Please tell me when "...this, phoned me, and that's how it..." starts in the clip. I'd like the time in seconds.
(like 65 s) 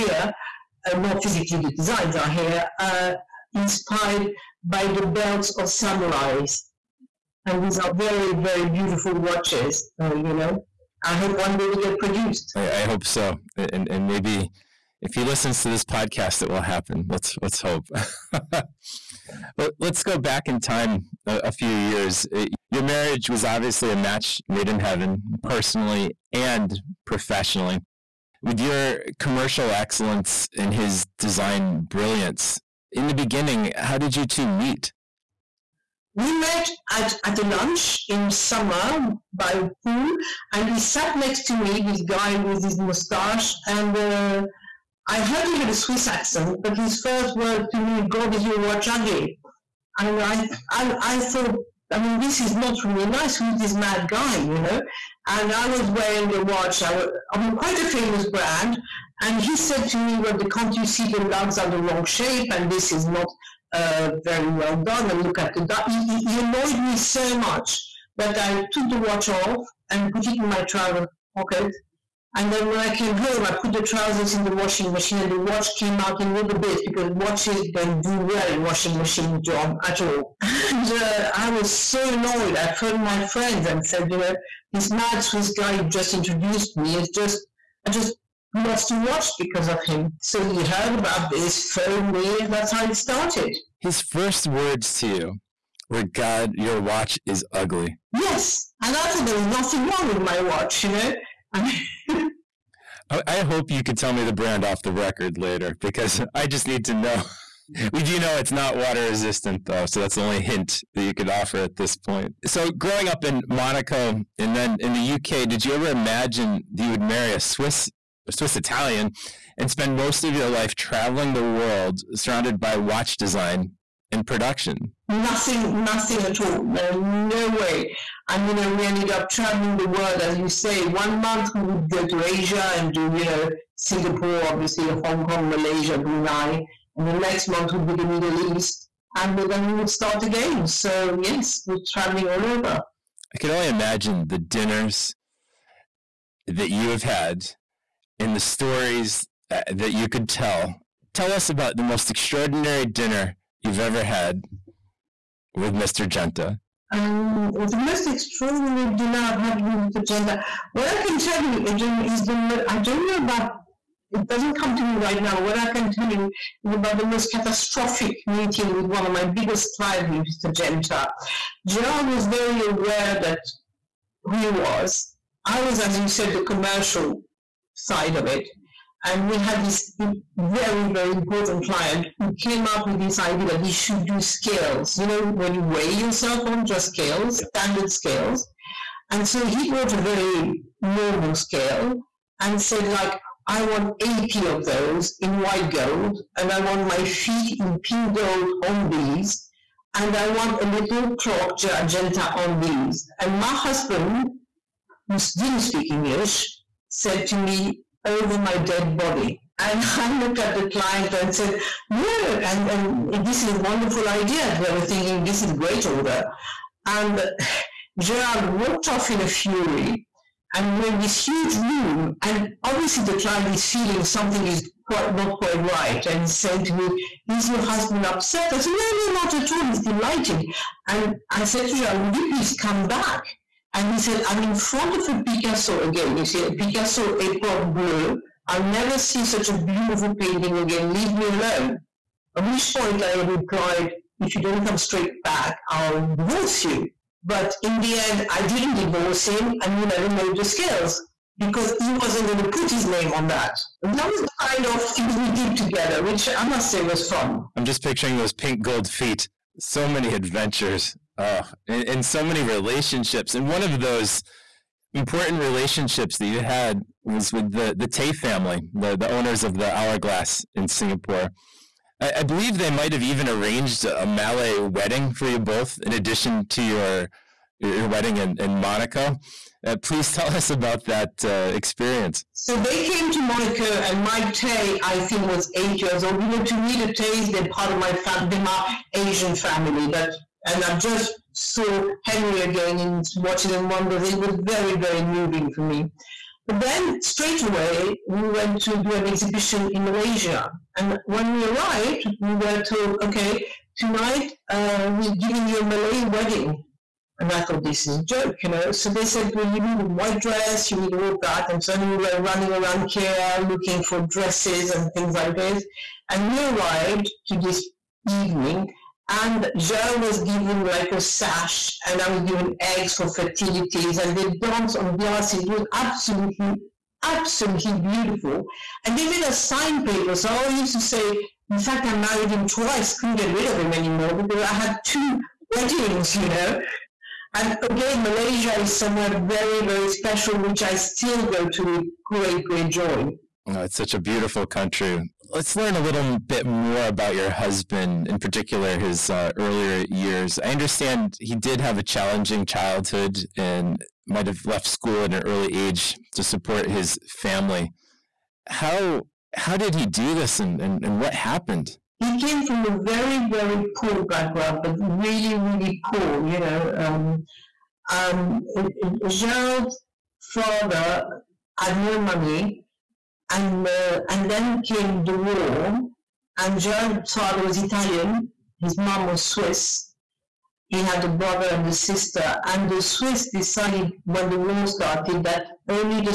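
91 s.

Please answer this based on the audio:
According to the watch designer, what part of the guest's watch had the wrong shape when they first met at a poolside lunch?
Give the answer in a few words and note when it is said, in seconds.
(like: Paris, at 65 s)
The lugs, at 61 s.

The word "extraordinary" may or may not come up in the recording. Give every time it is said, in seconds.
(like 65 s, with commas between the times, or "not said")
152 s, 158 s.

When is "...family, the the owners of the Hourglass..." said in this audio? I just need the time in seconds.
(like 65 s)
268 s.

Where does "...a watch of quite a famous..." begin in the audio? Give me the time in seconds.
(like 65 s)
56 s.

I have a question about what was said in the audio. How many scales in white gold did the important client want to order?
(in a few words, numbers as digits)
80.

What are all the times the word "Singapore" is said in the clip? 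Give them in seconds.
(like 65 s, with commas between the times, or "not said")
133 s, 270 s.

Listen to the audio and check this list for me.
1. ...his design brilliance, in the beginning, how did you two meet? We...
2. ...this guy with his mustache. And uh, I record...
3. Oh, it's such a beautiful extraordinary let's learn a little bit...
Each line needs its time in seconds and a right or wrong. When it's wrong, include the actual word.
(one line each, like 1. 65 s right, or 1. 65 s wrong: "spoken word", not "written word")
1. 30 s right
2. 41 s wrong: "heard", not "record"
3. 343 s wrong: "country", not "extraordinary".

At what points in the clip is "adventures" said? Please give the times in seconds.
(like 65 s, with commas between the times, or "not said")
260 s.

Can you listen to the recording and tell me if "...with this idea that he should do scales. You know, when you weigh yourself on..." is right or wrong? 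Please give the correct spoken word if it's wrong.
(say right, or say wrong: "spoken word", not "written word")
right.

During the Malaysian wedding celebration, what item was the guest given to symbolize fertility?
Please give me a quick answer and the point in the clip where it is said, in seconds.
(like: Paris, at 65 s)
Eggs, at 322 s.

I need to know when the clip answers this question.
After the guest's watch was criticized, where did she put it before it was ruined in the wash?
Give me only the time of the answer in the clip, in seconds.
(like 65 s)
70 s.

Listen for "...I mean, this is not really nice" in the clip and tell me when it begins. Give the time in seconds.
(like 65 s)
51 s.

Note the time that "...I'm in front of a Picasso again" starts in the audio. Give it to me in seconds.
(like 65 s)
234 s.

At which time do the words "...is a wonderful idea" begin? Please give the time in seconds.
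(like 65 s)
213 s.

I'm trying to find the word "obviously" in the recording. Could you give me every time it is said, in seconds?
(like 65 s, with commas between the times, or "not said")
23 s, 134 s, 222 s.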